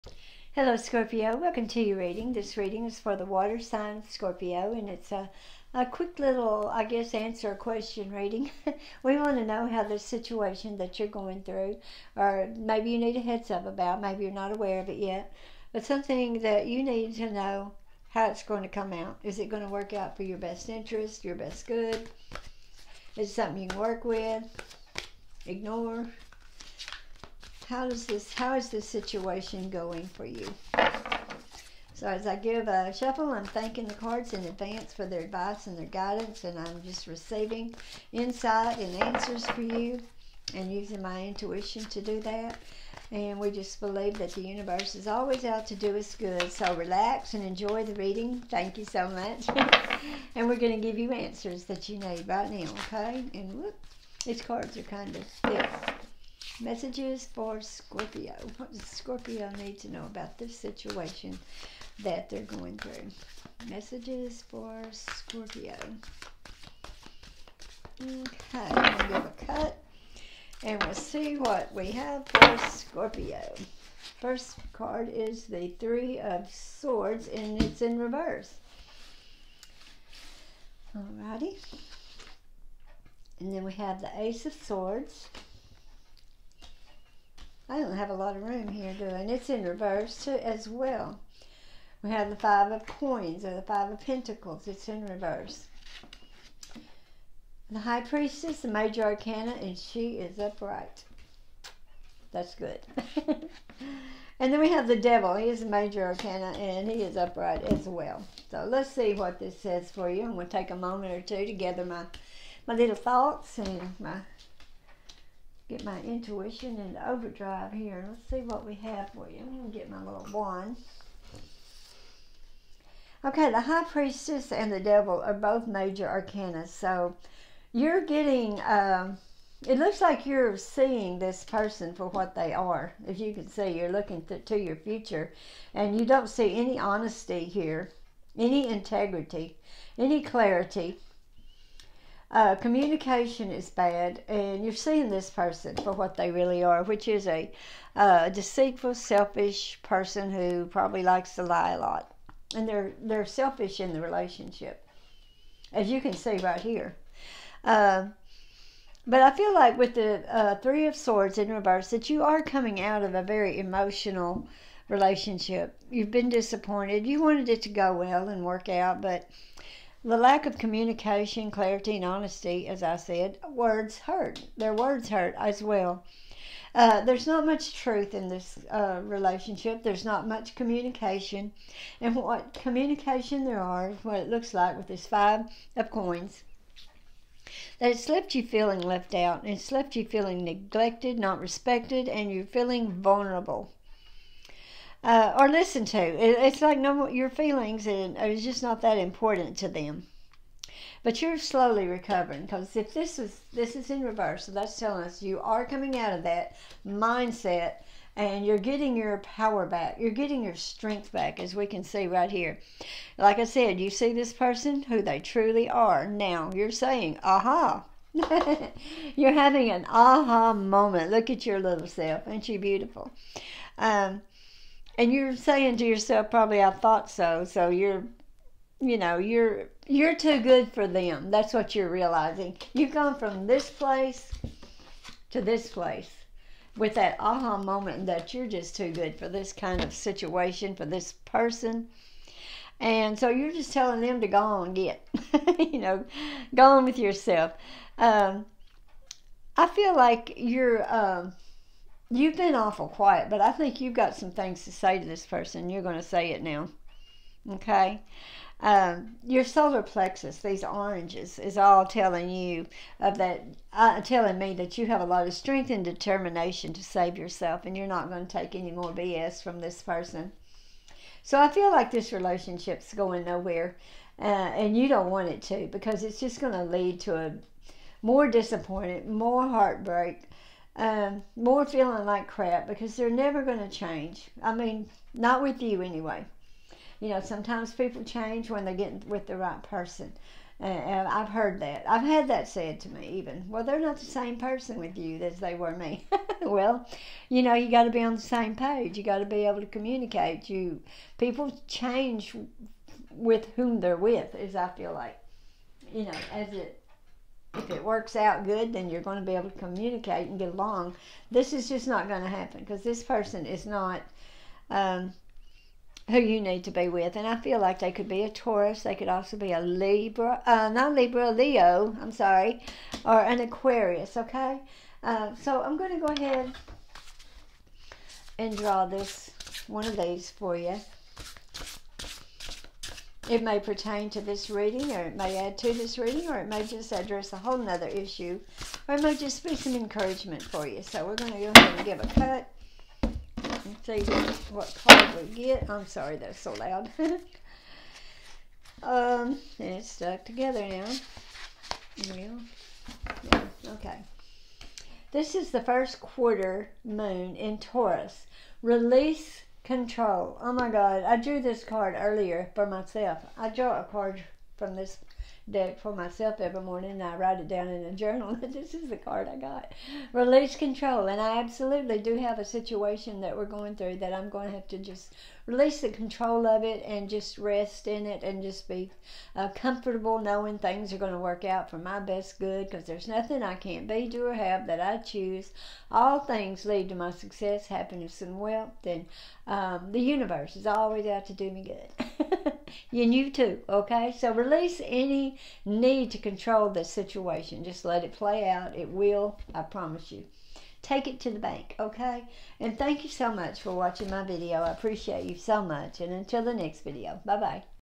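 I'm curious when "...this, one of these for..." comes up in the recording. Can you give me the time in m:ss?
5:28.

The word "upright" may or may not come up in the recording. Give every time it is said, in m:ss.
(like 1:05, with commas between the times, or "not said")
1:40, 1:47.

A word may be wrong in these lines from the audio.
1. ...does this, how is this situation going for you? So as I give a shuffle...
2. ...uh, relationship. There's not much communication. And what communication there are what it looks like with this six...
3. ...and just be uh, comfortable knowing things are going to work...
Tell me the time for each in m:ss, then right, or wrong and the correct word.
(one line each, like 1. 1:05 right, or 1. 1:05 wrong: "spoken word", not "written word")
1. 0:27 right
2. 2:58 wrong: "five", not "six"
3. 6:18 right.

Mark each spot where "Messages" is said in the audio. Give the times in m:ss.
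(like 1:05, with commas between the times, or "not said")
0:56, 1:03.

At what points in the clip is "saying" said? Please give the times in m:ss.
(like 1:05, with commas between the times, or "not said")
3:36, 3:45.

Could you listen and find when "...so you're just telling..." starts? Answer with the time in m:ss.
4:03.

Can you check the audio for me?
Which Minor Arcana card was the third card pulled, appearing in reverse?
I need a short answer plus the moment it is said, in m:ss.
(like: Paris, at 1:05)
Five of Pentacles, at 1:33.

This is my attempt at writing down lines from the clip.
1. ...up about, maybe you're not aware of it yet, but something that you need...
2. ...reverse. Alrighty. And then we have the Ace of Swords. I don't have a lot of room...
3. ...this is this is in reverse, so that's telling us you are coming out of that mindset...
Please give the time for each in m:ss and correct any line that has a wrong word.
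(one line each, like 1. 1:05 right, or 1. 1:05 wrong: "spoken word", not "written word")
1. 0:13 right
2. 1:17 right
3. 3:22 right.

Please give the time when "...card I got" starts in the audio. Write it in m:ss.
6:08.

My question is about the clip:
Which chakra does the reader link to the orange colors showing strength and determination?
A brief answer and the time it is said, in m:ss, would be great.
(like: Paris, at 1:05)
Solar plexus, at 4:19.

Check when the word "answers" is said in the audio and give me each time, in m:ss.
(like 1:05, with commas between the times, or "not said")
0:07, 0:39, 0:51.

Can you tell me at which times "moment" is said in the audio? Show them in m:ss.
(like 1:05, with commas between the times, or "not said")
1:50, 3:40, 3:57.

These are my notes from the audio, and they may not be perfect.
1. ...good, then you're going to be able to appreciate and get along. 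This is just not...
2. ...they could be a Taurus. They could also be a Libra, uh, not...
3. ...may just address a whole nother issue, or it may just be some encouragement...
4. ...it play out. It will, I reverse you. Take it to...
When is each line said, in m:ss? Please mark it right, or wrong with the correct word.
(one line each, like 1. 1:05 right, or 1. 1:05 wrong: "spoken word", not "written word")
1. 5:08 wrong: "communicate", not "appreciate"
2. 5:17 right
3. 5:36 right
4. 6:38 wrong: "promise", not "reverse".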